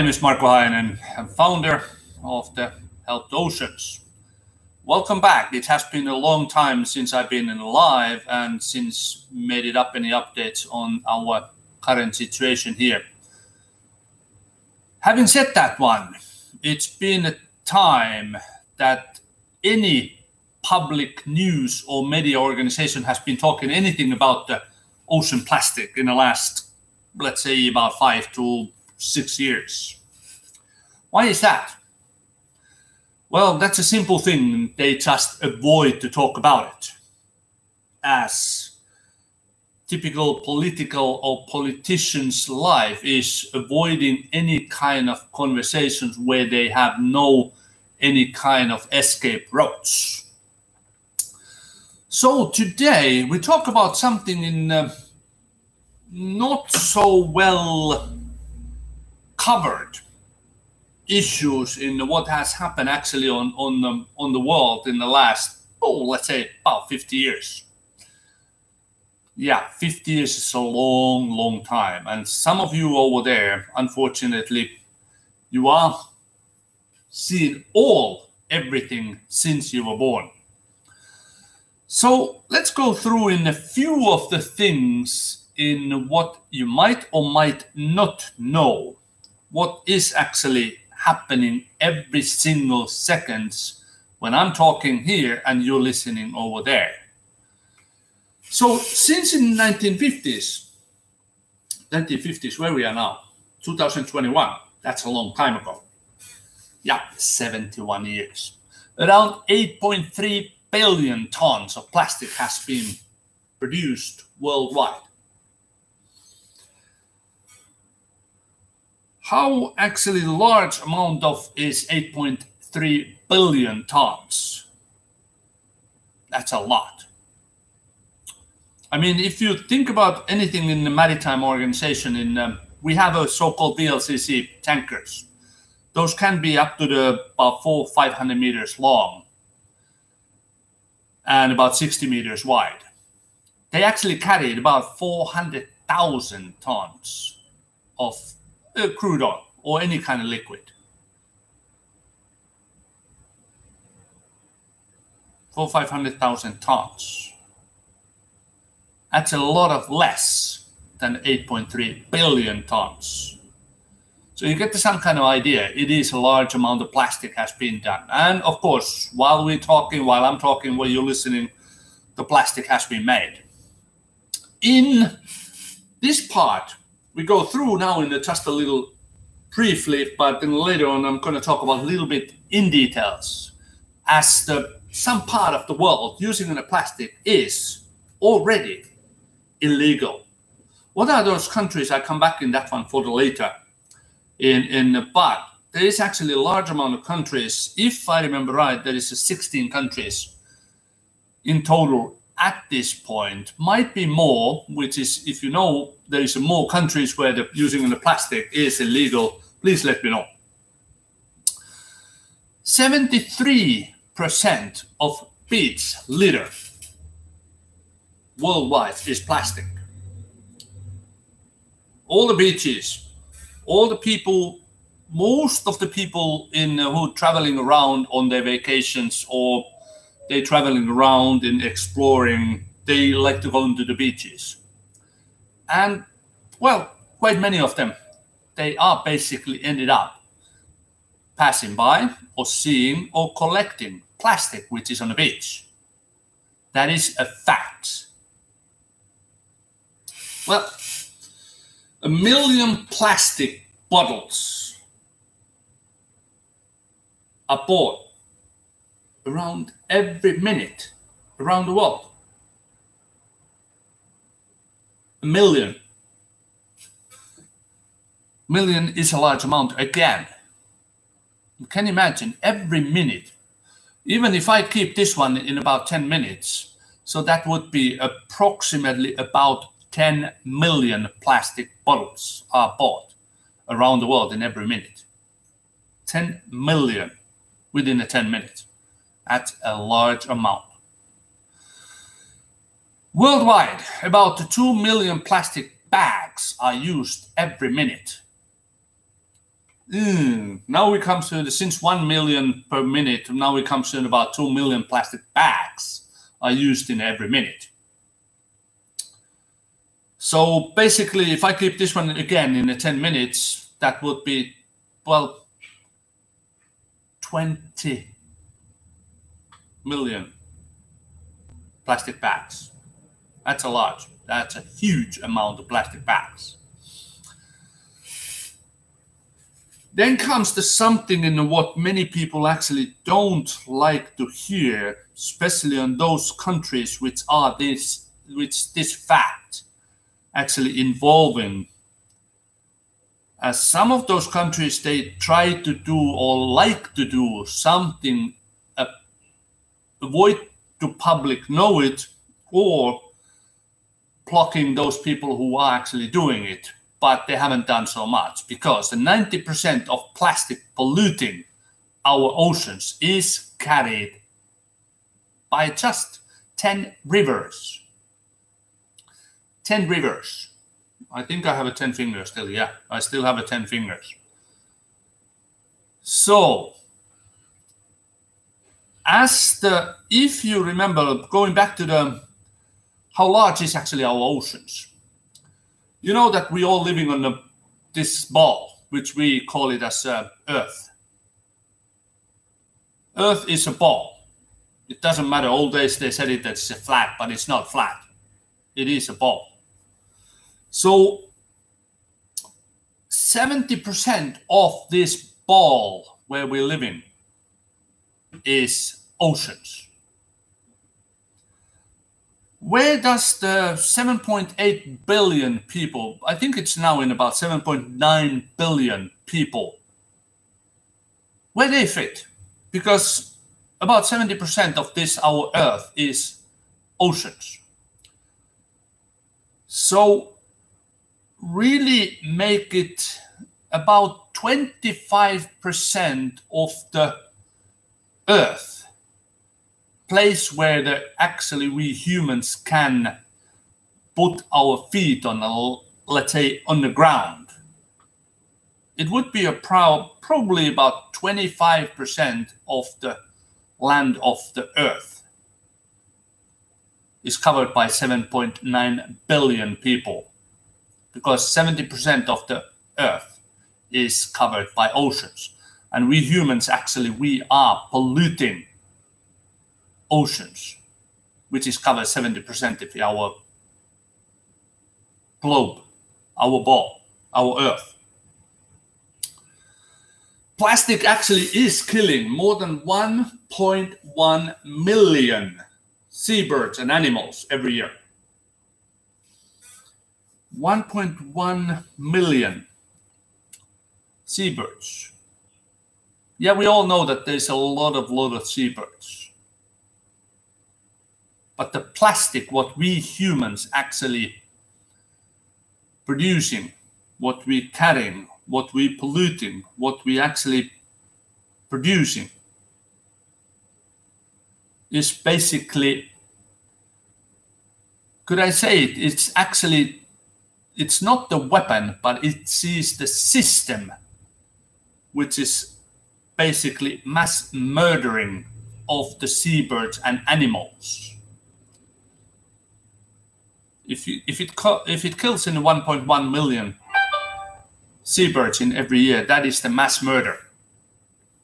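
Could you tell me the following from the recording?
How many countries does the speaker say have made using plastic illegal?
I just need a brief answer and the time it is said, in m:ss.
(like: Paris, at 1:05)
16, at 3:19.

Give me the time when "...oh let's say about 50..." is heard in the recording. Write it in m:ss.
1:05.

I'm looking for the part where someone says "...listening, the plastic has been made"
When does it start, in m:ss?
2:51.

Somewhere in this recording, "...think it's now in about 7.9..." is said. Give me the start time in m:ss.
6:56.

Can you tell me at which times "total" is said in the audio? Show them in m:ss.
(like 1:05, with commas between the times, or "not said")
3:21.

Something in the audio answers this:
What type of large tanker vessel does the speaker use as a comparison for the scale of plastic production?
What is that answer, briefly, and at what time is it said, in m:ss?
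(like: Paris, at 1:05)
VLCC tankers, at 2:13.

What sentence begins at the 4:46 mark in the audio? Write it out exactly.
10 million within the 10 minutes at a large amount.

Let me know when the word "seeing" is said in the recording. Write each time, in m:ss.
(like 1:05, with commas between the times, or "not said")
1:17, 4:02.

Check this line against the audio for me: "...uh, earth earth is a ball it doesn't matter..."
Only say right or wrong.
right.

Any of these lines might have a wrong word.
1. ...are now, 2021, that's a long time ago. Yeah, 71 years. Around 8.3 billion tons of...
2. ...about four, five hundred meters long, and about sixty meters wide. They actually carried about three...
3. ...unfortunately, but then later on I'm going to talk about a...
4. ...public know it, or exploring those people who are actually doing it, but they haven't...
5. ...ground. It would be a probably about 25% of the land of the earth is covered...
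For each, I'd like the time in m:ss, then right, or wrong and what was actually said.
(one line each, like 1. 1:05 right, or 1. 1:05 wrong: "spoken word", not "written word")
1. 1:42 right
2. 2:17 wrong: "four", not "three"
3. 2:59 wrong: "briefly", not "unfortunately"
4. 5:50 wrong: "blocking", not "exploring"
5. 7:26 right.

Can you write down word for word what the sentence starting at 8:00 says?
Plastic actually is killing more than 1.1 million seabirds and animals every year.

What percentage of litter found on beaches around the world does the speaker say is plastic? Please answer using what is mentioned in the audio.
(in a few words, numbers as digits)
73%.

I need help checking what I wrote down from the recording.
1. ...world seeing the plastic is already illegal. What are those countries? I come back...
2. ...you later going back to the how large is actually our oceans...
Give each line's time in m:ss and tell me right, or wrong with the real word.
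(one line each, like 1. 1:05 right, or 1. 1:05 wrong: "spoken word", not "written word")
1. 3:05 wrong: "using", not "seeing"
2. 6:20 wrong: "remember", not "later".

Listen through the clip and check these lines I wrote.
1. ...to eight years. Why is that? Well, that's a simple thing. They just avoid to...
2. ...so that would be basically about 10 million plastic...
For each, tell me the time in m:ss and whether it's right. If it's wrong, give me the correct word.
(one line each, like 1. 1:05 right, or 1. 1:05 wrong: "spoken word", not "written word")
1. 0:28 wrong: "six", not "eight"
2. 4:37 wrong: "approximately", not "basically".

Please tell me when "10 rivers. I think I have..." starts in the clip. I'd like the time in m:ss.
6:09.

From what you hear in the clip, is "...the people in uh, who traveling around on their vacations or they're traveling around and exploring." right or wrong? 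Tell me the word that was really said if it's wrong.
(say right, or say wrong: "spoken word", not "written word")
right.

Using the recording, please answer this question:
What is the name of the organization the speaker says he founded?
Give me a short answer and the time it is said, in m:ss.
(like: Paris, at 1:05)
Help The Oceans, at 0:03.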